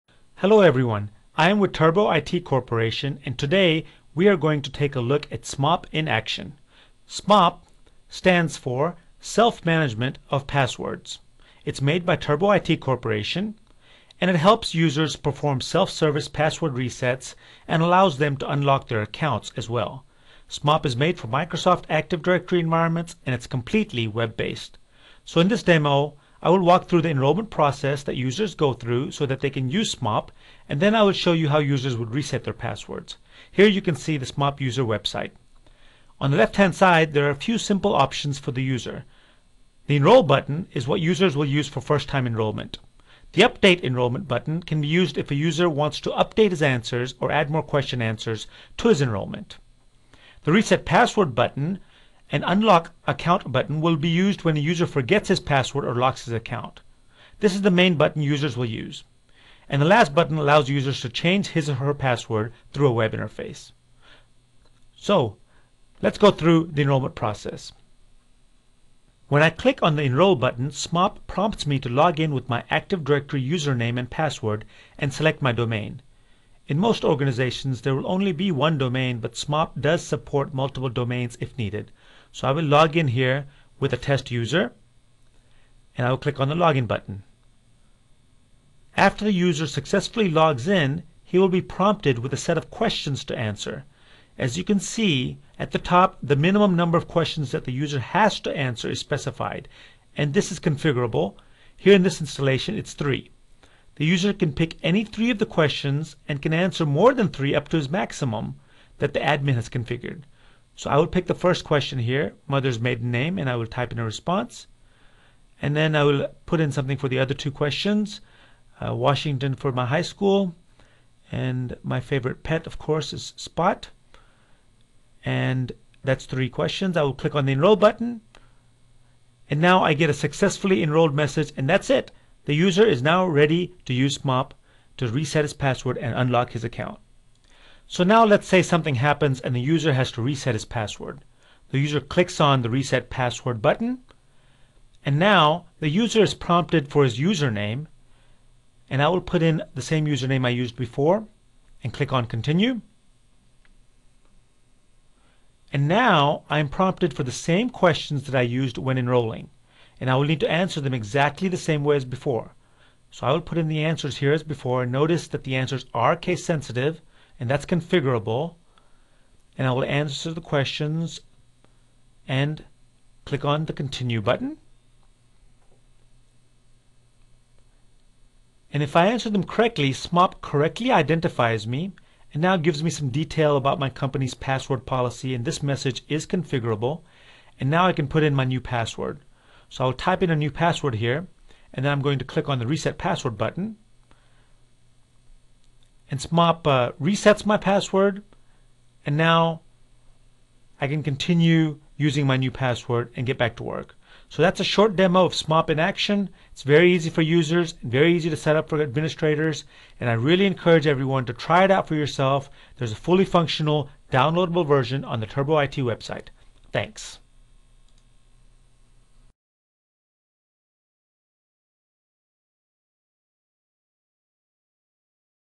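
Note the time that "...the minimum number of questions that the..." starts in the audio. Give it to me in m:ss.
1:36.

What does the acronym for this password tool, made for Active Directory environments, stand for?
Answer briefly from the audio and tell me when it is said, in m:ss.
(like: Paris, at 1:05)
Self-Management of Passwords, at 0:09.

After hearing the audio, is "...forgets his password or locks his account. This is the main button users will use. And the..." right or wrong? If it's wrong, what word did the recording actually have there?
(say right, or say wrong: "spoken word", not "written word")
right.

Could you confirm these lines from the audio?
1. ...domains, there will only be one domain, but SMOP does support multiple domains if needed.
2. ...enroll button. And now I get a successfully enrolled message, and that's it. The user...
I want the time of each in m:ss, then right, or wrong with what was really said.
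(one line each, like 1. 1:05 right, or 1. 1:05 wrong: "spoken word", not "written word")
1. 1:17 wrong: "organizations", not "domains"
2. 2:07 right.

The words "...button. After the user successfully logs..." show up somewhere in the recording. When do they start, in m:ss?
1:26.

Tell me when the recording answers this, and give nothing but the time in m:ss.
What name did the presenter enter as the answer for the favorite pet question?
2:03.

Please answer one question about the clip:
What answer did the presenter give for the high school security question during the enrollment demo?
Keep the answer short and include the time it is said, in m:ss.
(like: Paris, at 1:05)
Washington, at 1:58.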